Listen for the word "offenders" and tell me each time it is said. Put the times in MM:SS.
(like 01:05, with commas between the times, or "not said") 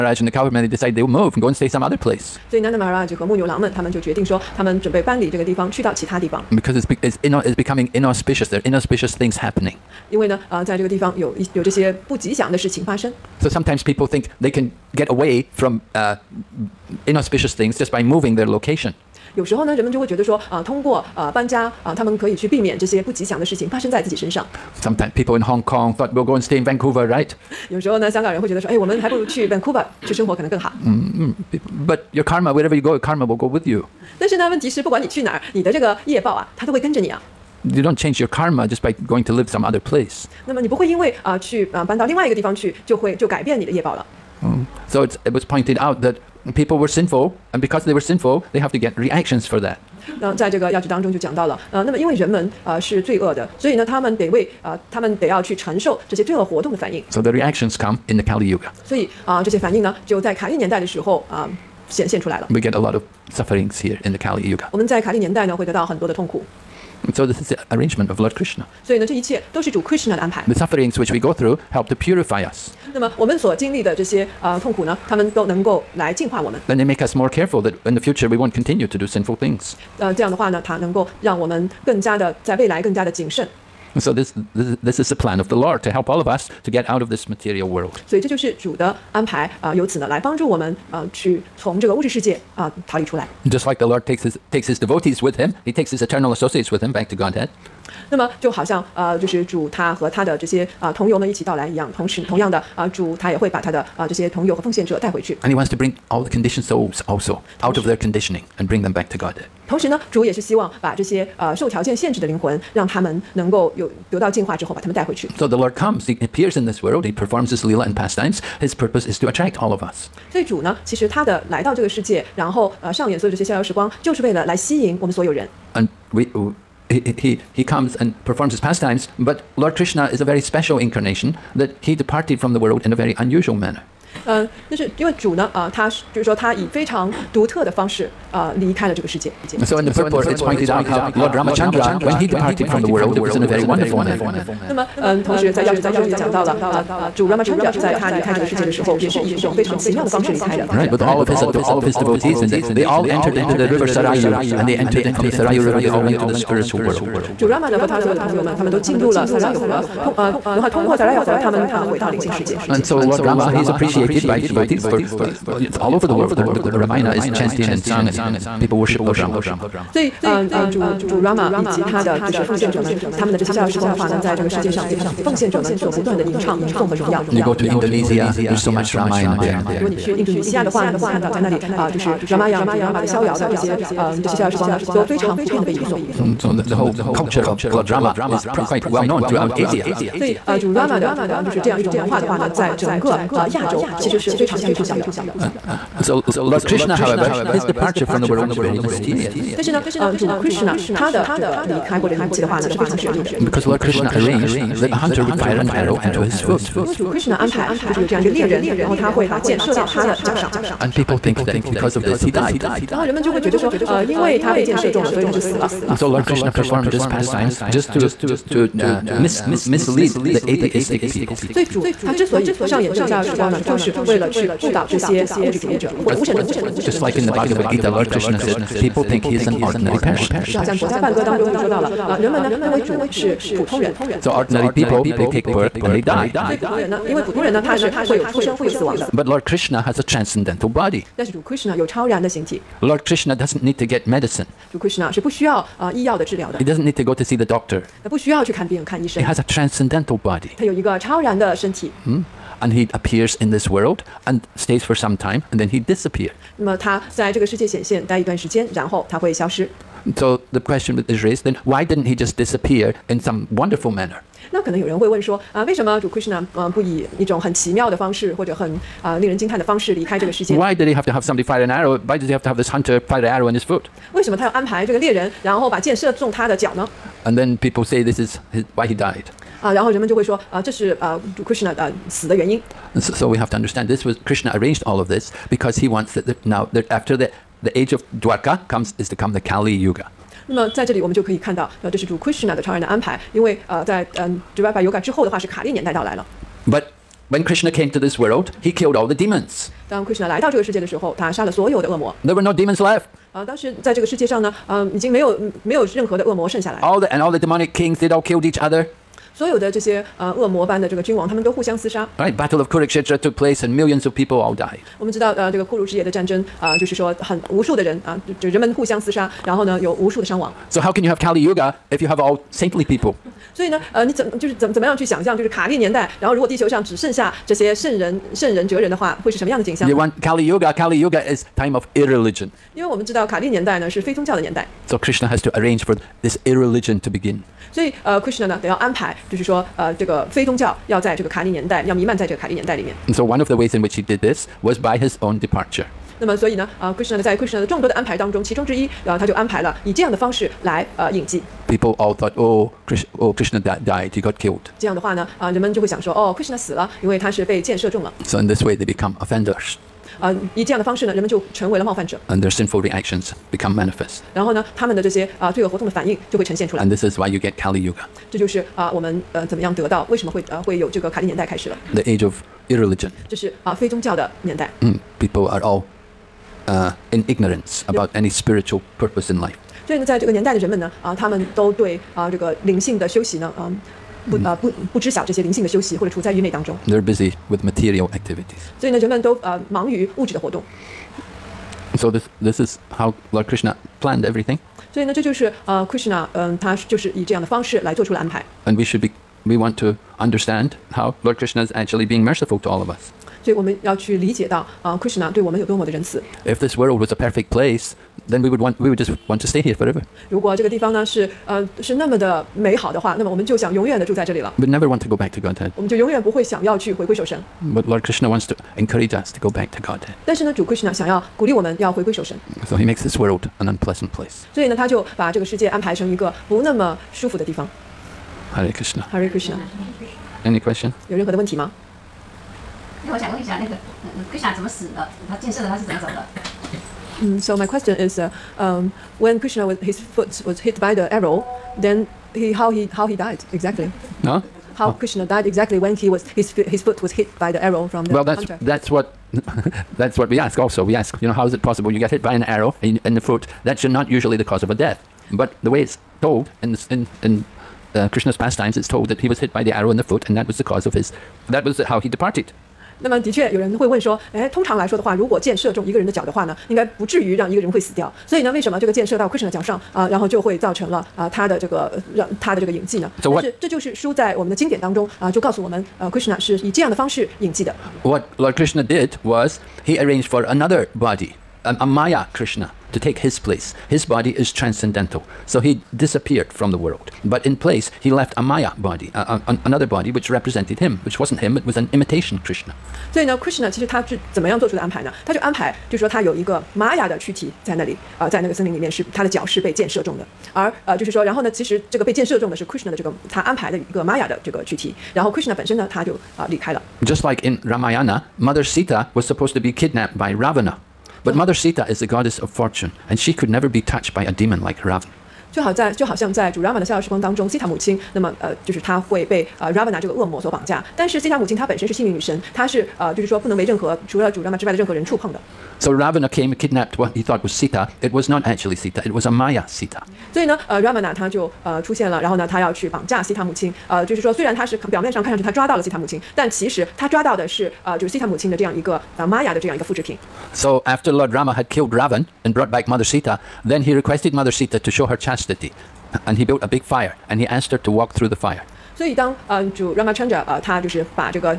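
05:59.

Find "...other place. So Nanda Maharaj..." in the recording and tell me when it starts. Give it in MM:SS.
00:01.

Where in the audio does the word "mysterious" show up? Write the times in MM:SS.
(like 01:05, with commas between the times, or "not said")
03:18.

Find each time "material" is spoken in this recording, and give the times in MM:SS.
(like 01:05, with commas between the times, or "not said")
01:27, 06:27.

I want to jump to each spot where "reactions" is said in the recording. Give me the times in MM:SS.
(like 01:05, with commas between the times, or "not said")
00:48, 00:57, 06:02.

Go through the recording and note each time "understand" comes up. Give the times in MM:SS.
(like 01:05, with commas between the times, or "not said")
04:43, 06:40.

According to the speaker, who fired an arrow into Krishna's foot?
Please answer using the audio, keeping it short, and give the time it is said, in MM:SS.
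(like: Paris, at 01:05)
A hunter, at 03:24.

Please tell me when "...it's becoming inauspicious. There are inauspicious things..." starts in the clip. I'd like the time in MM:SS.
00:07.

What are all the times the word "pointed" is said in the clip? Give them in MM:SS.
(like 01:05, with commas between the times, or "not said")
00:45, 02:20.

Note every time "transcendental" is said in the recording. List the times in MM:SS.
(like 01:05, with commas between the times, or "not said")
04:00, 04:09, 08:04.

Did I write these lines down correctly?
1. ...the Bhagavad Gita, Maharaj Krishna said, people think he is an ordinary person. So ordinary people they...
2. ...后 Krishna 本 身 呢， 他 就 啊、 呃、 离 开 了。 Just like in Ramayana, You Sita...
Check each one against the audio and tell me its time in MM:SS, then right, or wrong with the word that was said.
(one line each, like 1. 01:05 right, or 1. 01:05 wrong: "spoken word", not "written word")
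1. 03:47 wrong: "Lord", not "Maharaj"
2. 08:25 wrong: "Mother", not "You".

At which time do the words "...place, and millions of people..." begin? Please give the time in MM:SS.
05:13.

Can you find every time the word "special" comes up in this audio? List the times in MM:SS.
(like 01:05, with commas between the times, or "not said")
02:10.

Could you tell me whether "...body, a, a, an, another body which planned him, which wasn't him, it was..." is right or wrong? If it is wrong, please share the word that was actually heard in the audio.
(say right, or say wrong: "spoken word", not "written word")
wrong: "represented", not "planned".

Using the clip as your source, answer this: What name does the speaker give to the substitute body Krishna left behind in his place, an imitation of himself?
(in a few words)
Maya Krishna.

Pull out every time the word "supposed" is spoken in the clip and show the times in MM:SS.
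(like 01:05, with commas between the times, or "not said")
08:29.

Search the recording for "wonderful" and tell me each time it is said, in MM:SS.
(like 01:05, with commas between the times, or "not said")
02:23, 04:23.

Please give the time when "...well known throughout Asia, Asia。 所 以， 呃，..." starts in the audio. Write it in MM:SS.
03:08.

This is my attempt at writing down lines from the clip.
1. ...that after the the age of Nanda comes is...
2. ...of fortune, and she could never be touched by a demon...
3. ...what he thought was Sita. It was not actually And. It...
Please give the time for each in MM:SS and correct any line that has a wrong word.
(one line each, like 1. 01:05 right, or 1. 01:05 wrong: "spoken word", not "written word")
1. 04:46 wrong: "Dwarka", not "Nanda"
2. 08:32 right
3. 08:46 wrong: "Sita", not "And".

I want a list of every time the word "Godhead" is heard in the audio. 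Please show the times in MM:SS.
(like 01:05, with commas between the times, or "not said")
01:37, 06:55, 06:59.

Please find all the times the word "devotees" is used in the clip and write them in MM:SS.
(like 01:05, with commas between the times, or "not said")
01:34, 02:31, 02:44.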